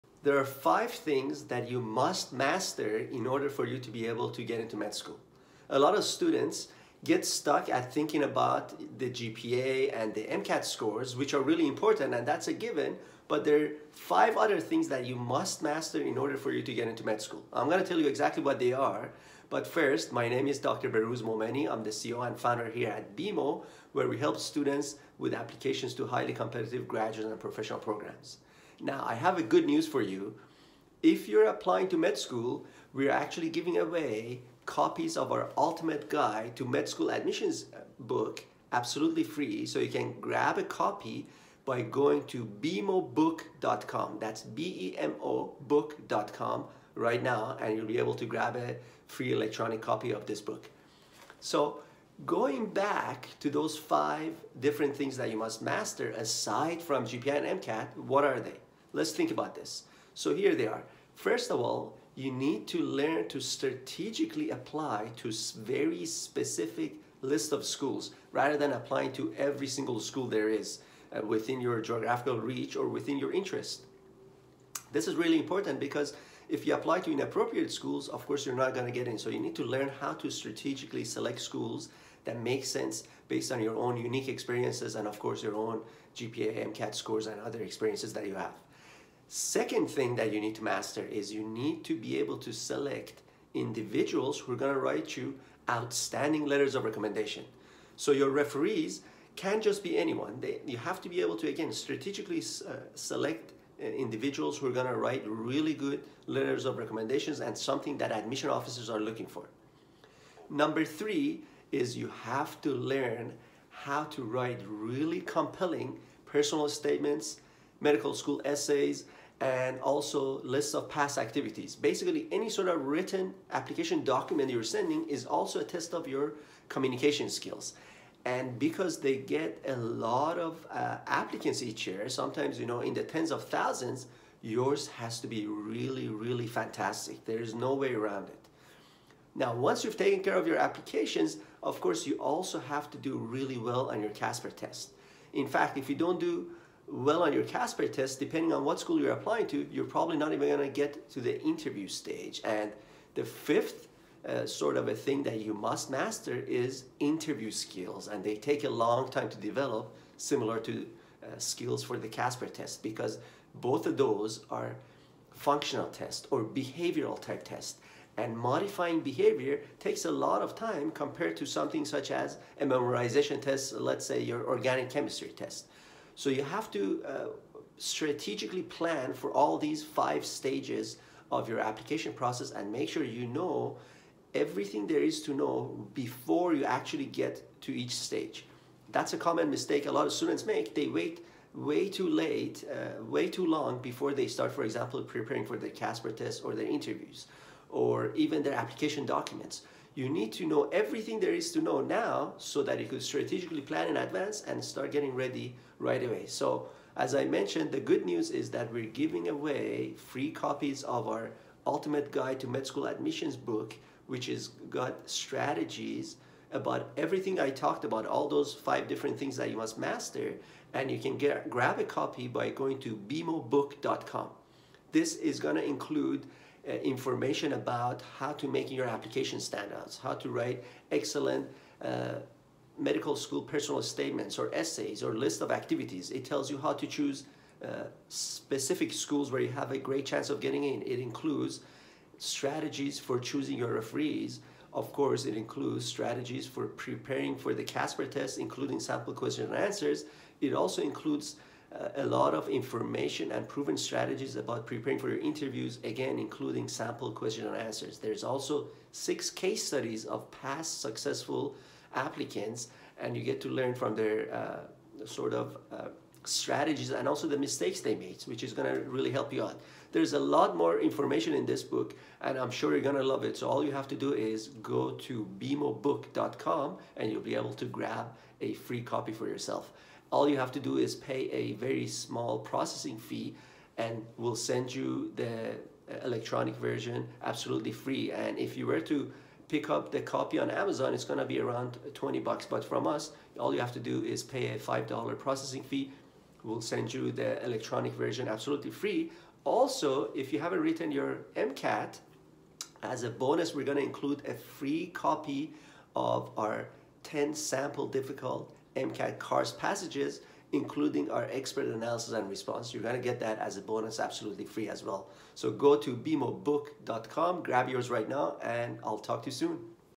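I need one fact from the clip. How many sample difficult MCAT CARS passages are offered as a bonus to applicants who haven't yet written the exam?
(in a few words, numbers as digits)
10.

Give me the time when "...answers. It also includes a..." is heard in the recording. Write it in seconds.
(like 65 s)
249 s.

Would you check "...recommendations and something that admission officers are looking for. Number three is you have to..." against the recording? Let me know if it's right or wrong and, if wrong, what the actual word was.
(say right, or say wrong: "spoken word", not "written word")
right.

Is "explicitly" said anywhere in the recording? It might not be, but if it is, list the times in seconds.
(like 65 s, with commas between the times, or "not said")
not said.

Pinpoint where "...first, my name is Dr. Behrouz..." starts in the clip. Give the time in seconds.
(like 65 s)
19 s.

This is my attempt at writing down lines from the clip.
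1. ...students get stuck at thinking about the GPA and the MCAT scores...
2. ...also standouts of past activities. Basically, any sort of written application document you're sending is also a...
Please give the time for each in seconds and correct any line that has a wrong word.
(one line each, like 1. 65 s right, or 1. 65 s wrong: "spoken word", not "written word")
1. 6 s right
2. 119 s wrong: "lists", not "standouts".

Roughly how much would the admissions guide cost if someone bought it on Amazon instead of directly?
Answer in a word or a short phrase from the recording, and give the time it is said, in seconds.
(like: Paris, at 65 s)
$20, at 291 s.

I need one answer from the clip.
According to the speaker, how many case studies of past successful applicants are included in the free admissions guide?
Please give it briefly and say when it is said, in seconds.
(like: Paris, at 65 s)
6, at 258 s.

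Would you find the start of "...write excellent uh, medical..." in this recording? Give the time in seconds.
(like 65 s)
230 s.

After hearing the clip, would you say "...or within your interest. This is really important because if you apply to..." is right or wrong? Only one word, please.
right.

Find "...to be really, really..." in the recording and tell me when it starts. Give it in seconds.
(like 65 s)
135 s.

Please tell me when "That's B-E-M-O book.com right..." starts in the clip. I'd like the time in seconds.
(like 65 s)
44 s.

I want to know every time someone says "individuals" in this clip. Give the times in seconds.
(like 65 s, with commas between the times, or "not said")
93 s, 103 s.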